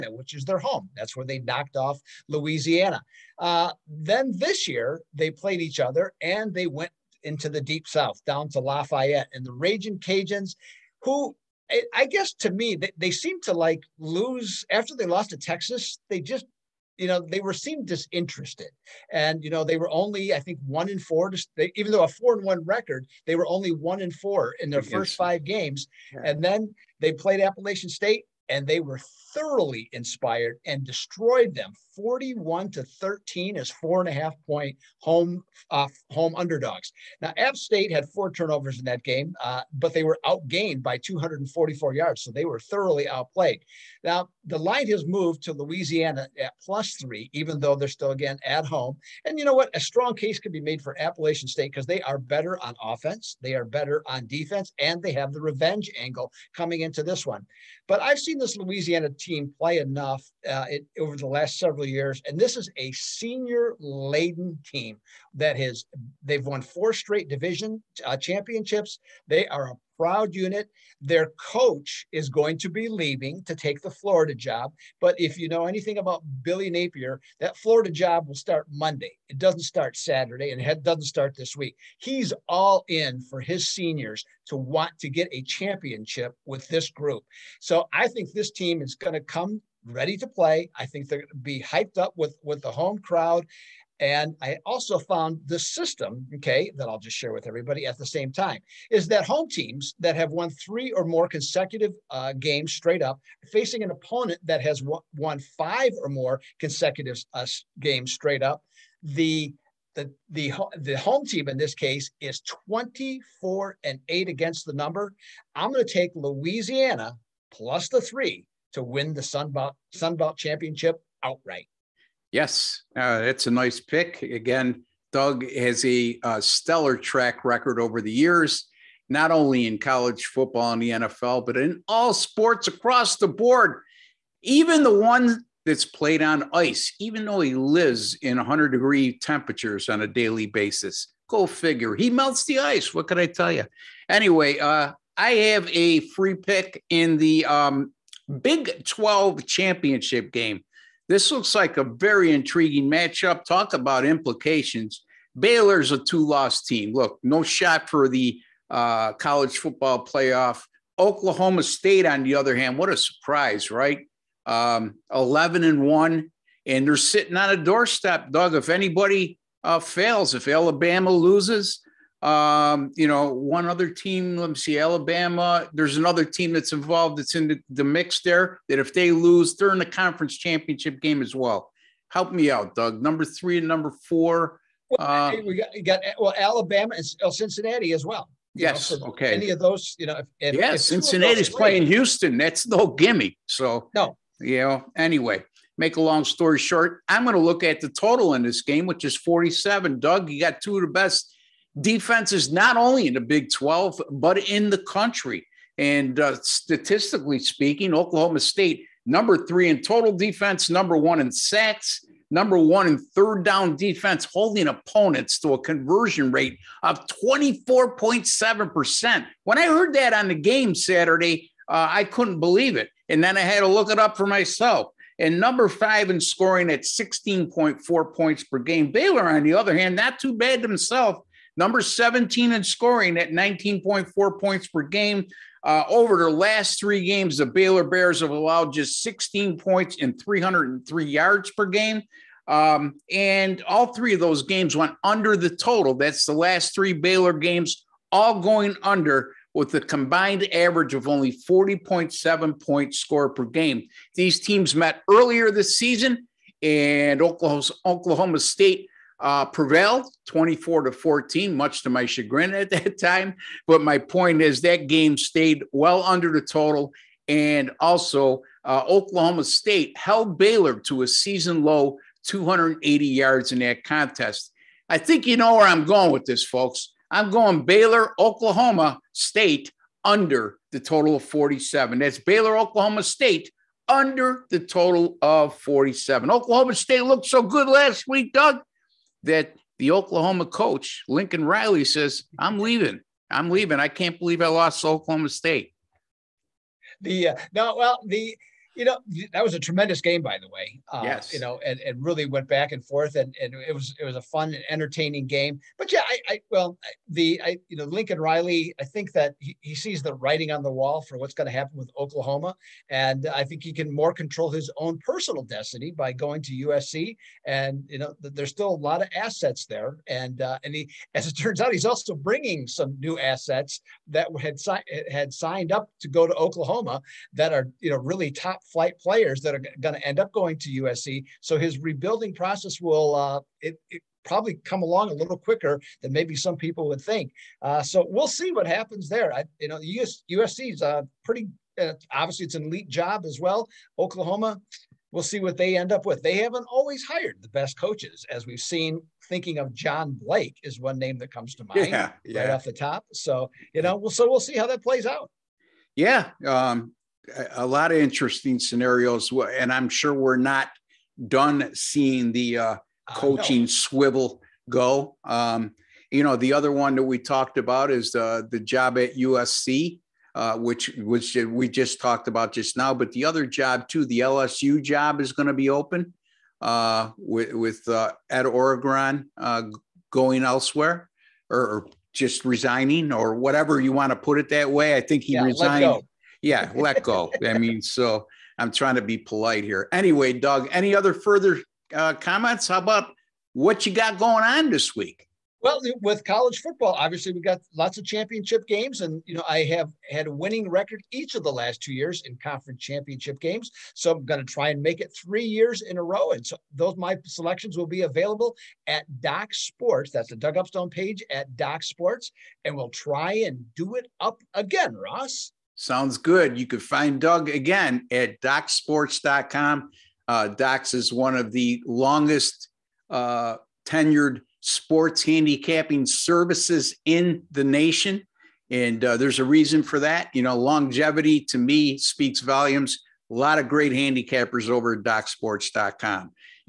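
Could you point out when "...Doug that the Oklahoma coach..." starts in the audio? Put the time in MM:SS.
04:48.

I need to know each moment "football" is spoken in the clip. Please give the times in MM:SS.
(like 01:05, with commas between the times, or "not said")
02:10, 02:39, 06:36.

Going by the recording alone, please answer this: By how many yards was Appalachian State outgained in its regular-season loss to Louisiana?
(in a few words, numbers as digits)
244.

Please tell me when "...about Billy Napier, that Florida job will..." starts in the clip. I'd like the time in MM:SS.
01:15.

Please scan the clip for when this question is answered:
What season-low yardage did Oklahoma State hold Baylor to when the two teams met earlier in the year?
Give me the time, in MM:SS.
04:32.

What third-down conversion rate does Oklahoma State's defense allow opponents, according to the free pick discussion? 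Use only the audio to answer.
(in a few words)
24.7%.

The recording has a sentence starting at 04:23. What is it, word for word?
But my point is that game stayed well under the total.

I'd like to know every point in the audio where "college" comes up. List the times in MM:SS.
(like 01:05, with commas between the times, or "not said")
02:09, 02:39, 06:36.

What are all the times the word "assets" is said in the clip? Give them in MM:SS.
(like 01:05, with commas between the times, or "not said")
05:19, 05:23.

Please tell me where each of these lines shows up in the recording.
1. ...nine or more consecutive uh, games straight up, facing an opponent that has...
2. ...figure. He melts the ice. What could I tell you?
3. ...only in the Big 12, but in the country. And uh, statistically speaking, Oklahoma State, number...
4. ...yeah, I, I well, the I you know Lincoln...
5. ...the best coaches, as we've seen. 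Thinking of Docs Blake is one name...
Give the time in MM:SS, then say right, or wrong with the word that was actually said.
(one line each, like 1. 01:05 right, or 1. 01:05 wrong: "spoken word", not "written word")
1. 01:40 wrong: "three", not "nine"
2. 02:21 right
3. 03:22 right
4. 05:05 right
5. 05:47 wrong: "John", not "Docs".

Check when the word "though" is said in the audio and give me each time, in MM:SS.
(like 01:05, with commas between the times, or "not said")
00:21, 00:47, 02:17.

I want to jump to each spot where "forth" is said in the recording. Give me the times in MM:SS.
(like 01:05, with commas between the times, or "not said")
05:02.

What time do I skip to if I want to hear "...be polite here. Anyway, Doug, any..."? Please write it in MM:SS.
06:29.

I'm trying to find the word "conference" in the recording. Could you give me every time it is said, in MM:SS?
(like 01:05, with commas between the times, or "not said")
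02:59, 06:42.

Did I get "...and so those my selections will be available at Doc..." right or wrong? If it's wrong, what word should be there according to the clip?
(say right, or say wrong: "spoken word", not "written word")
right.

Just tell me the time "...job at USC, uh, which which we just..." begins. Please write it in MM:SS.
06:08.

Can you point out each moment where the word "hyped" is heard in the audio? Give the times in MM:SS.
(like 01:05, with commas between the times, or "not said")
01:31.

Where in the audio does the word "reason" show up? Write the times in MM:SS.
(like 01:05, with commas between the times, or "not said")
07:09.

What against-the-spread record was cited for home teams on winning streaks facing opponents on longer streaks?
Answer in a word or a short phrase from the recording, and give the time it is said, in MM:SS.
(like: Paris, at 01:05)
24-8, at 01:52.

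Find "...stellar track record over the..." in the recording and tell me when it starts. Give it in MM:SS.
02:06.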